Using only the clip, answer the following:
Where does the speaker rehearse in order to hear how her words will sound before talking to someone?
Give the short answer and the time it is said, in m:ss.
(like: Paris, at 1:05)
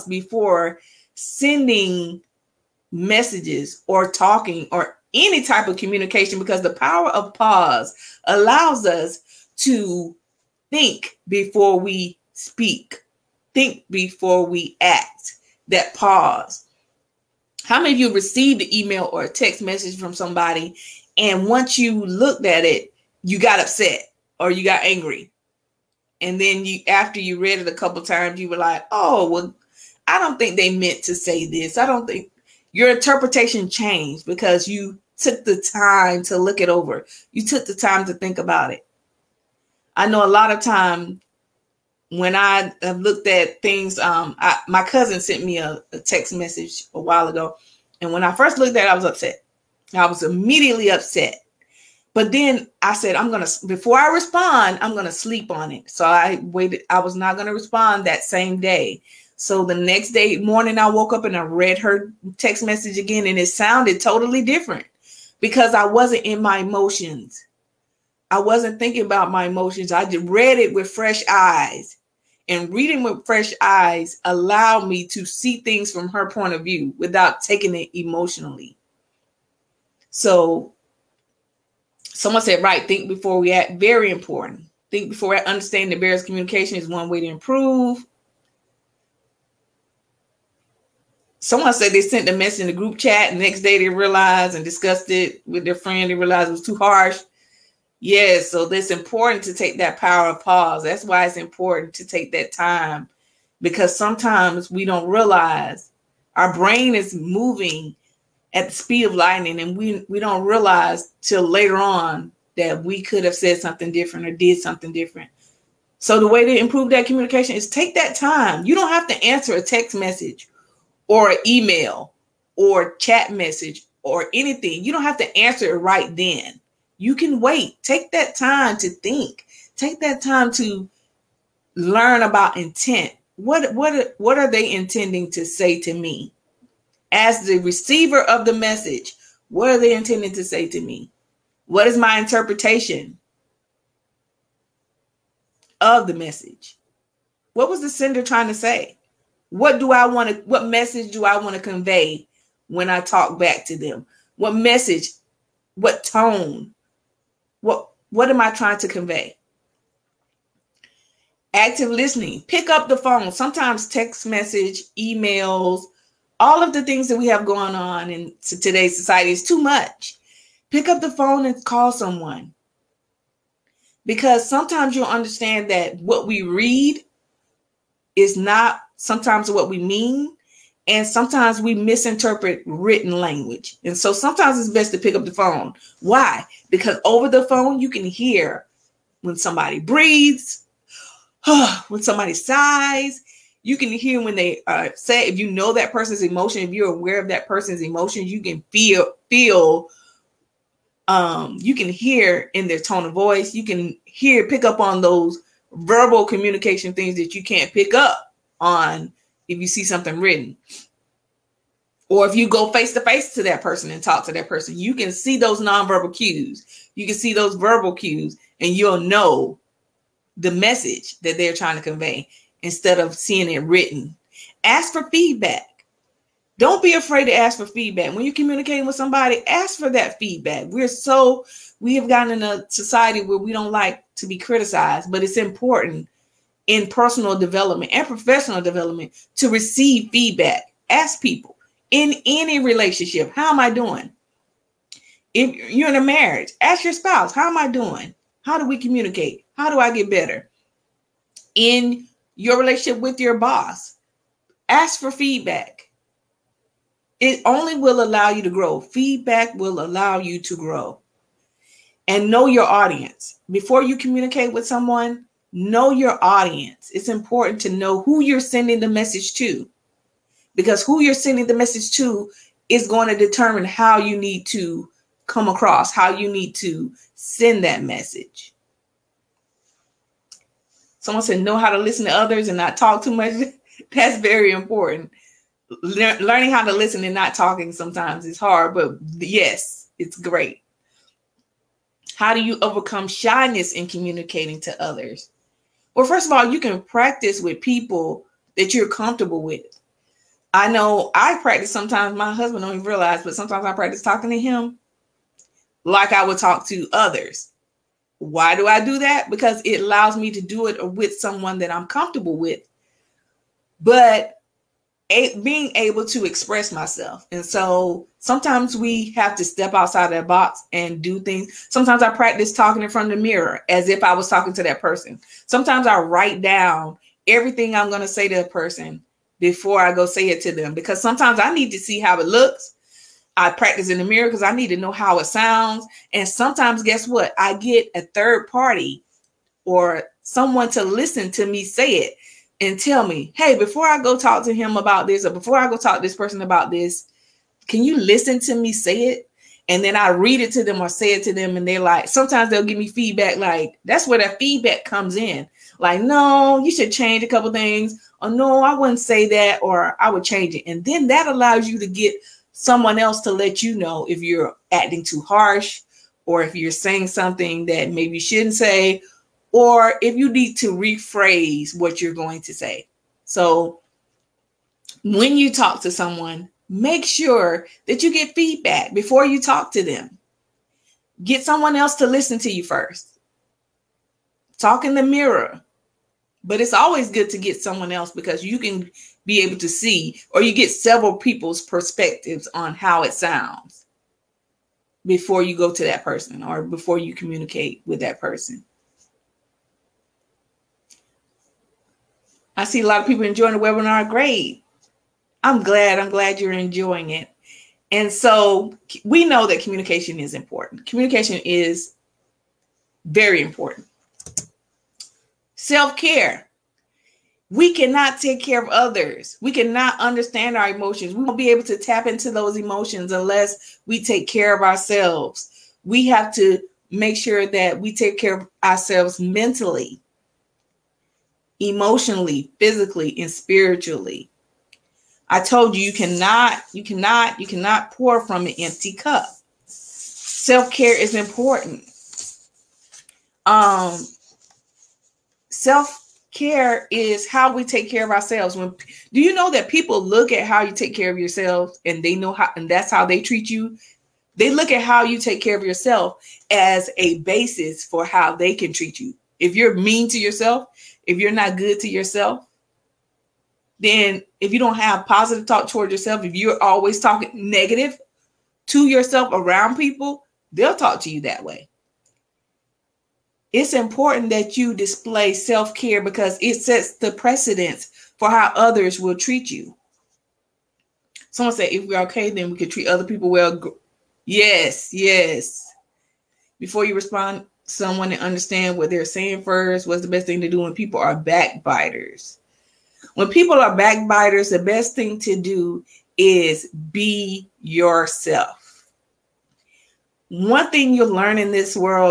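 In front of the mirror, at 5:22.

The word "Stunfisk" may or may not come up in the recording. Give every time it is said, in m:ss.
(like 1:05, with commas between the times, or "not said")
not said.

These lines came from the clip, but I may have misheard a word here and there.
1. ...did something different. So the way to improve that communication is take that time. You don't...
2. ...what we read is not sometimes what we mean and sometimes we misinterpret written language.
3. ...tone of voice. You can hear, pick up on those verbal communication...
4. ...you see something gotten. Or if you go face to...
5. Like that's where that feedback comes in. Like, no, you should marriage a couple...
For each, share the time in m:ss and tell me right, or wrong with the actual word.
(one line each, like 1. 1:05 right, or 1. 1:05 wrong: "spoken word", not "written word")
1. 1:54 right
2. 2:55 right
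3. 3:22 right
4. 3:29 wrong: "written", not "gotten"
5. 5:53 wrong: "change", not "marriage".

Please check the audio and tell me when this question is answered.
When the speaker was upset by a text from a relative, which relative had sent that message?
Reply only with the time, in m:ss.
0:44.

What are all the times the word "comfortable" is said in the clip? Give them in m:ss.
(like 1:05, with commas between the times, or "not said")
4:58, 5:11.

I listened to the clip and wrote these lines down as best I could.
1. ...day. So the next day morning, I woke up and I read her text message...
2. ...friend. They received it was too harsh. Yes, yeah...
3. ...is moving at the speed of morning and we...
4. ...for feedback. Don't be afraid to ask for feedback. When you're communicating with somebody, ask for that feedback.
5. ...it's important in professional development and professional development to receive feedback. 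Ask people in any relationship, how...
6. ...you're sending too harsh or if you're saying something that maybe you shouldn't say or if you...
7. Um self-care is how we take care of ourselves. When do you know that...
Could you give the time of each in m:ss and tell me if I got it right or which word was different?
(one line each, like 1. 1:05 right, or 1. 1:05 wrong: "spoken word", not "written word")
1. 0:58 right
2. 1:35 wrong: "realized", not "received"
3. 1:46 wrong: "lightning", not "morning"
4. 3:44 right
5. 3:55 wrong: "personal", not "professional"
6. 6:04 wrong: "acting", not "sending"
7. 7:23 right.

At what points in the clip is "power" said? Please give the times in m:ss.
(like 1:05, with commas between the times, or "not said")
0:06, 1:39.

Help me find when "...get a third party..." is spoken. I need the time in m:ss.
5:37.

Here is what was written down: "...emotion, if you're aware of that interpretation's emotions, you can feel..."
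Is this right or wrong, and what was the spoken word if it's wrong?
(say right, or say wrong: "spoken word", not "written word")
wrong: "person", not "interpretation".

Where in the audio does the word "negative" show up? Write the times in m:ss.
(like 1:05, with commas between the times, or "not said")
7:47.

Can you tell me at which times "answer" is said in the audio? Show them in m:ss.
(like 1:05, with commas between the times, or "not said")
1:59, 2:05.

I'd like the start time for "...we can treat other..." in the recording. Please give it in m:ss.
8:02.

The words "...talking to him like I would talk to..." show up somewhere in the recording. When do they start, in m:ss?
5:03.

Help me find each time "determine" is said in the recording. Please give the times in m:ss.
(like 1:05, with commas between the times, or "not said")
4:33.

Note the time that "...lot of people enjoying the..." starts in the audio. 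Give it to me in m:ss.
6:42.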